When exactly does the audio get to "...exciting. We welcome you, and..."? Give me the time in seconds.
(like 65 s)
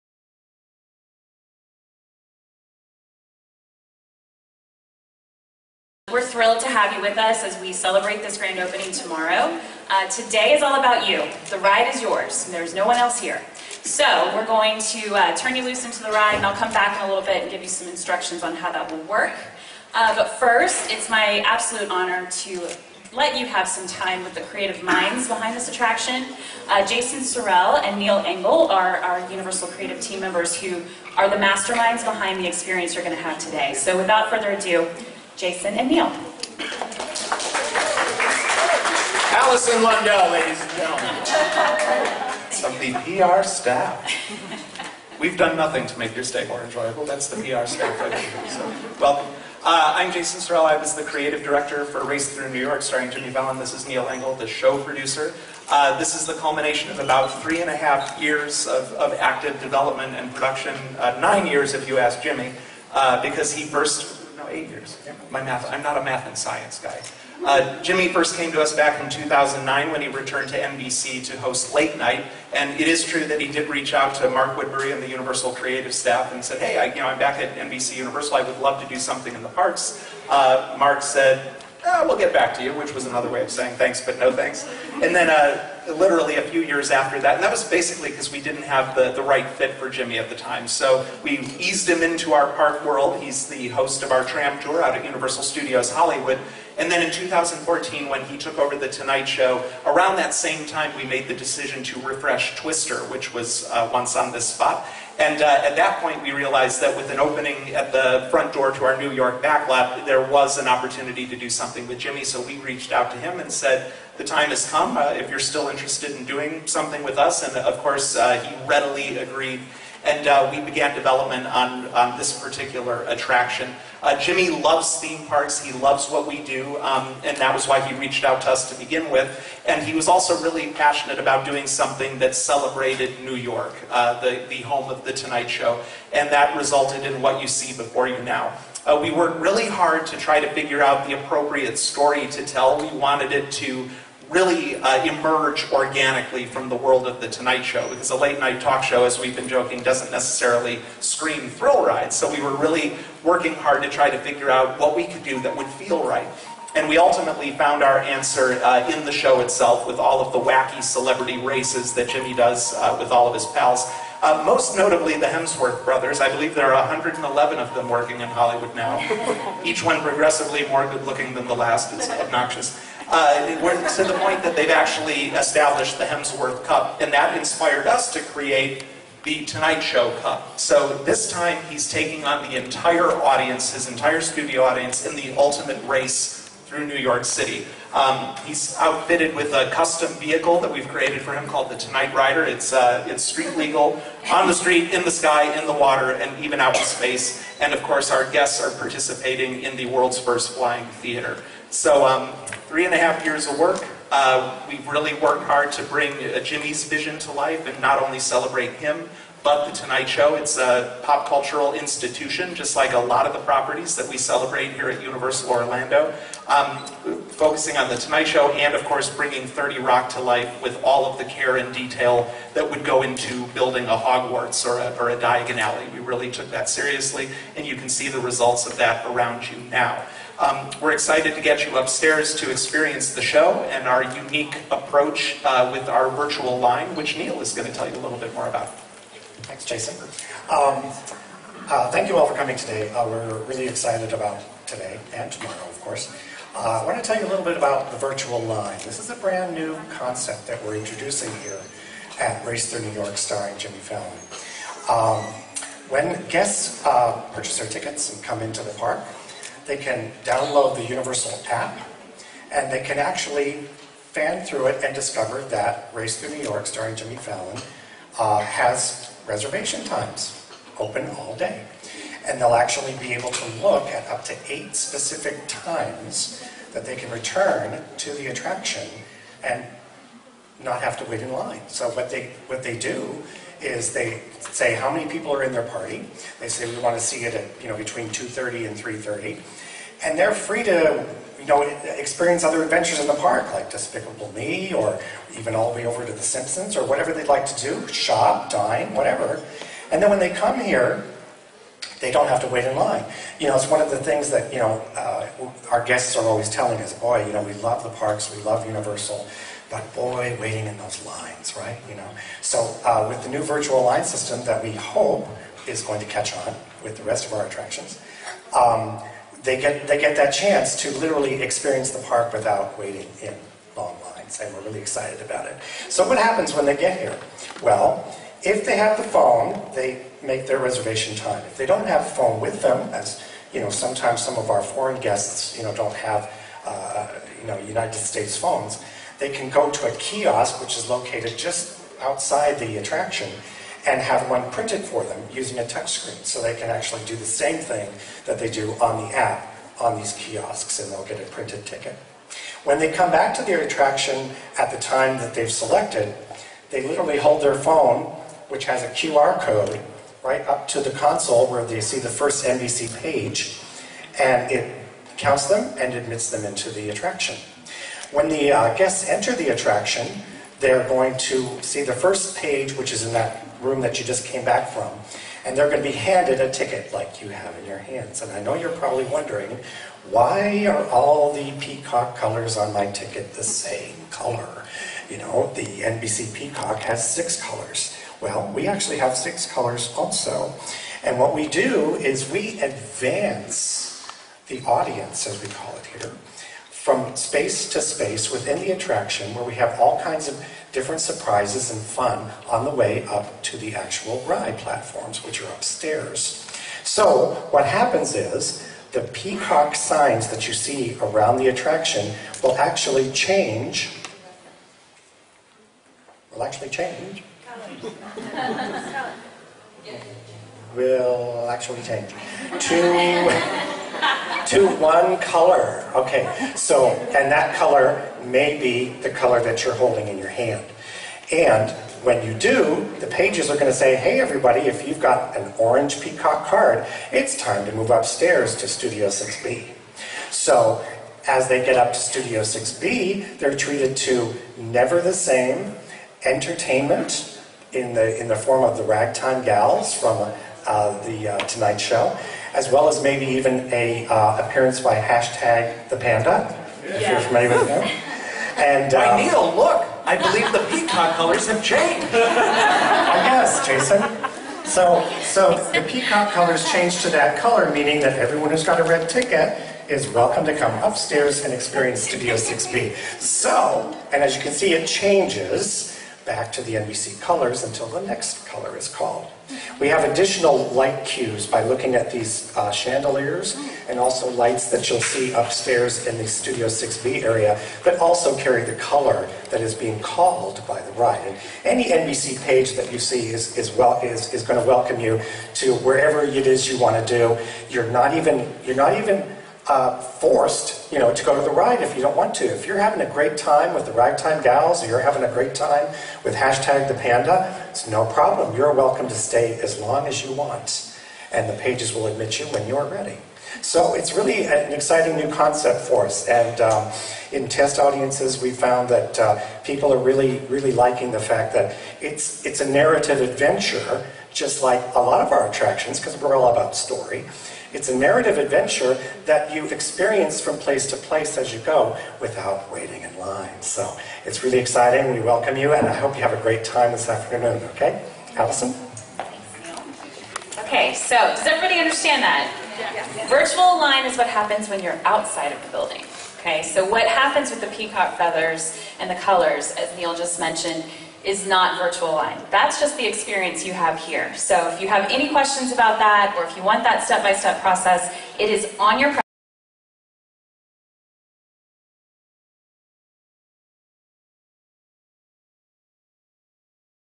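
534 s.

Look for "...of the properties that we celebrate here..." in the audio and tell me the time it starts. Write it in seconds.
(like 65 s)
213 s.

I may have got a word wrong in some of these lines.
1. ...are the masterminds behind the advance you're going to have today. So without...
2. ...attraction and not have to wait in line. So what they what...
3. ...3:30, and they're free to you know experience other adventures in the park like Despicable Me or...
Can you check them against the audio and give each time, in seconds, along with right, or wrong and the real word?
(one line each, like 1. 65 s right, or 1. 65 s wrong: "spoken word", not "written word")
1. 31 s wrong: "experience", not "advance"
2. 278 s right
3. 288 s right.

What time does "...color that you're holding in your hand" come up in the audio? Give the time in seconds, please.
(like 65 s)
429 s.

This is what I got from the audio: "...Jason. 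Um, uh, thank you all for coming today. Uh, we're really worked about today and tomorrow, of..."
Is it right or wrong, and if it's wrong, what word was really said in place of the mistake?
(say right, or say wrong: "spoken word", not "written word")
wrong: "excited", not "worked".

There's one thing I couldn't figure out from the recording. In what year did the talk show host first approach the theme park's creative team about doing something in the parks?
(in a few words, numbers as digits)
2009.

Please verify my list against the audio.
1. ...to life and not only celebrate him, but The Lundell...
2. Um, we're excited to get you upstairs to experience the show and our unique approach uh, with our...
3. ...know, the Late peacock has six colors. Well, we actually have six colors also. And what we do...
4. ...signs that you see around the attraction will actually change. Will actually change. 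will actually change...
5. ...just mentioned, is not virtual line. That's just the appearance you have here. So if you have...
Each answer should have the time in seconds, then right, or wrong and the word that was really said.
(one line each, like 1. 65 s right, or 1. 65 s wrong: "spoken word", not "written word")
1. 207 s wrong: "Tonight", not "Lundell"
2. 230 s right
3. 385 s wrong: "NBC", not "Late"
4. 409 s right
5. 550 s wrong: "experience", not "appearance".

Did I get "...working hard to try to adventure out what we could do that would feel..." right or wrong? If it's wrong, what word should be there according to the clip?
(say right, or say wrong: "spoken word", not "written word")
wrong: "figure", not "adventure".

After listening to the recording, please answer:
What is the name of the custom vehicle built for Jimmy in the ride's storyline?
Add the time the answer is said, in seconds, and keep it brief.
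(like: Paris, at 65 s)
Tonight Rider, at 191 s.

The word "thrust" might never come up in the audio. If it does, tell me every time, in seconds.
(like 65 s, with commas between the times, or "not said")
not said.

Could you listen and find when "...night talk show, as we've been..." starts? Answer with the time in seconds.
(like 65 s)
148 s.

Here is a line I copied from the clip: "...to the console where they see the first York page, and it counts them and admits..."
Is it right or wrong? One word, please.
wrong.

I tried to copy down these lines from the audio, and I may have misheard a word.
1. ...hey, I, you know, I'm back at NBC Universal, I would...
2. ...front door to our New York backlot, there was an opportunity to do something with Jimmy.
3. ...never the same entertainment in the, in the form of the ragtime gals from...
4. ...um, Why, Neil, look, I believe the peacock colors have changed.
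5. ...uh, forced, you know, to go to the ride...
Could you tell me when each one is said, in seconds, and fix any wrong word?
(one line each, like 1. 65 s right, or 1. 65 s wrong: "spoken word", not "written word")
1. 76 s right
2. 108 s right
3. 444 s right
4. 458 s right
5. 499 s right.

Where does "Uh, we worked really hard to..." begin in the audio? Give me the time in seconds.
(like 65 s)
138 s.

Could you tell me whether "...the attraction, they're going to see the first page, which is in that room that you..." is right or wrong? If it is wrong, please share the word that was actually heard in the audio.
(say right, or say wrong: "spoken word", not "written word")
right.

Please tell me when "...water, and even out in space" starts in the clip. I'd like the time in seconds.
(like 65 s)
195 s.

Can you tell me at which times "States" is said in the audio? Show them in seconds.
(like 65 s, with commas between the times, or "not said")
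337 s.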